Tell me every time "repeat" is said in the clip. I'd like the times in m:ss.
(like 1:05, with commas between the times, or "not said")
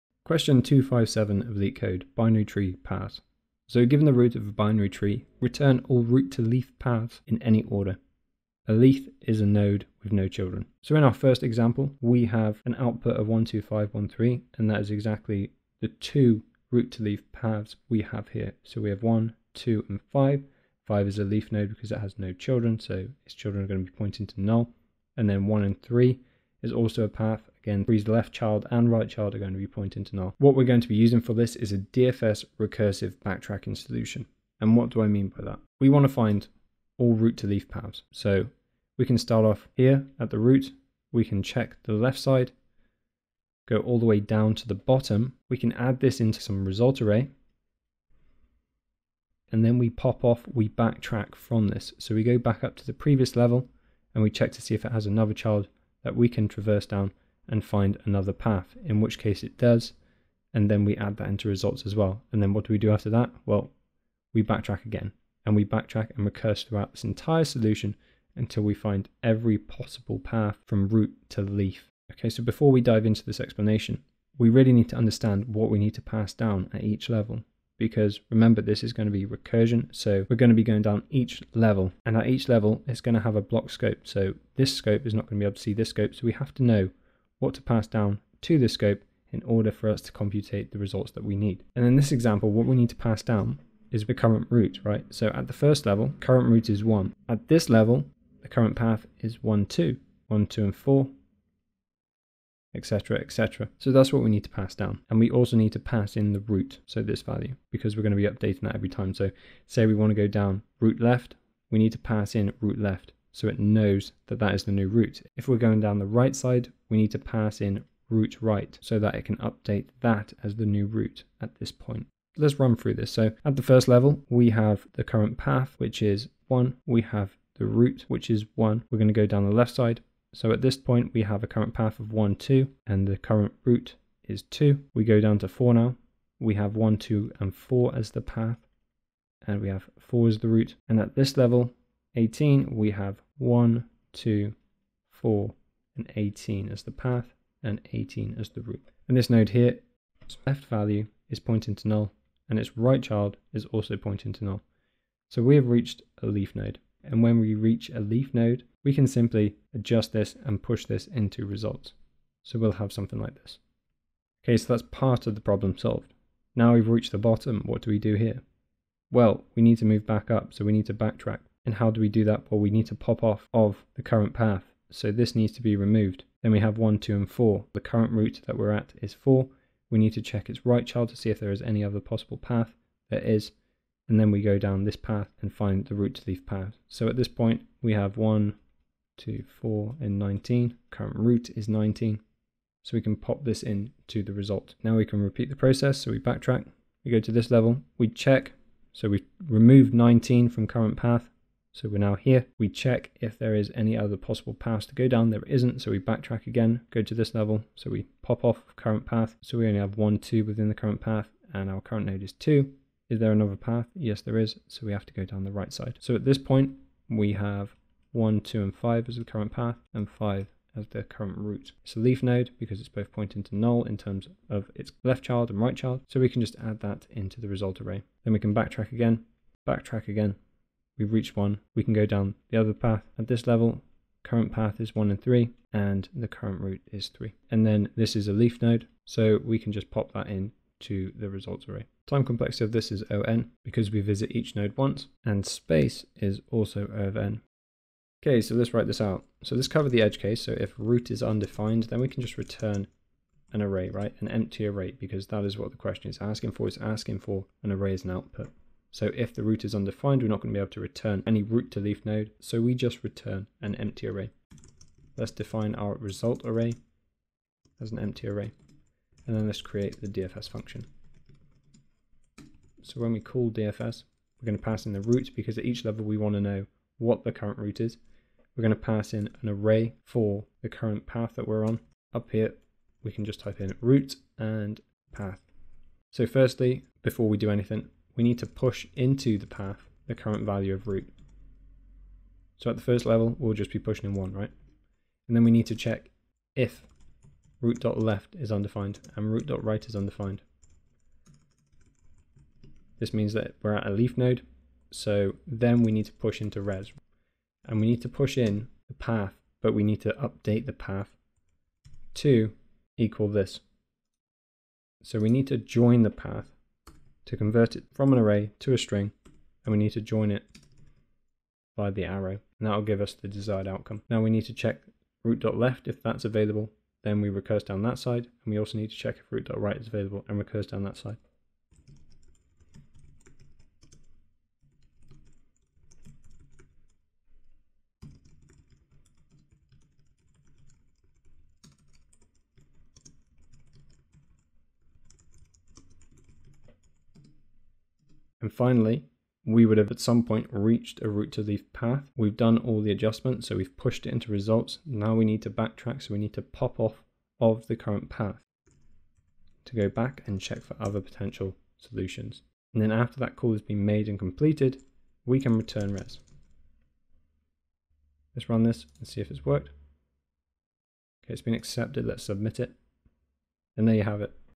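3:15.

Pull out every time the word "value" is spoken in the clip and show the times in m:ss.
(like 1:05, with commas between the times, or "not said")
1:47, 2:30, 4:50.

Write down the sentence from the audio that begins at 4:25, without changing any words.
Let's define our result array as an empty array, and then let's create the DFS function.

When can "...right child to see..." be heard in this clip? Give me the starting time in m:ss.
3:00.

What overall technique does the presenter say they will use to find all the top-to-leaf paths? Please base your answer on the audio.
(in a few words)
DFS recursive backtracking.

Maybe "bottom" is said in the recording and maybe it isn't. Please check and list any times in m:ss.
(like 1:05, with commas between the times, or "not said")
0:44, 2:47.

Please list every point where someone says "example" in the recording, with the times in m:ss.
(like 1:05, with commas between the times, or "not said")
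0:11, 1:32.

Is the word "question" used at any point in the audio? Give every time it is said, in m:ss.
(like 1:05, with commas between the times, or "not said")
0:00, 4:15.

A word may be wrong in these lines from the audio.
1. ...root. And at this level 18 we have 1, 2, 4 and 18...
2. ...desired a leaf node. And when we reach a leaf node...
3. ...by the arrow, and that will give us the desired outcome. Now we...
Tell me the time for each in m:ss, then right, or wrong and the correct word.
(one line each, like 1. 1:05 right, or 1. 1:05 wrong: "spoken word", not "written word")
1. 2:20 right
2. 2:35 wrong: "reached", not "desired"
3. 5:21 right.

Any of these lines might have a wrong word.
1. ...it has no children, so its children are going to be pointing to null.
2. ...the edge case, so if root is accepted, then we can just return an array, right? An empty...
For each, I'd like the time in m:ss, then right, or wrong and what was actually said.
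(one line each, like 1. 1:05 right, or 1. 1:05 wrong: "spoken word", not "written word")
1. 0:21 right
2. 4:09 wrong: "undefined", not "accepted".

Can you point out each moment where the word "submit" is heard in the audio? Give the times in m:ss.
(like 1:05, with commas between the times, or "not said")
6:12.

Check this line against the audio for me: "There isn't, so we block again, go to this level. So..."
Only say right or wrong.
wrong.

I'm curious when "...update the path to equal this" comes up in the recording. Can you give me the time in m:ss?
5:10.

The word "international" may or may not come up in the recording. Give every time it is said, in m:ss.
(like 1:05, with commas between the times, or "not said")
not said.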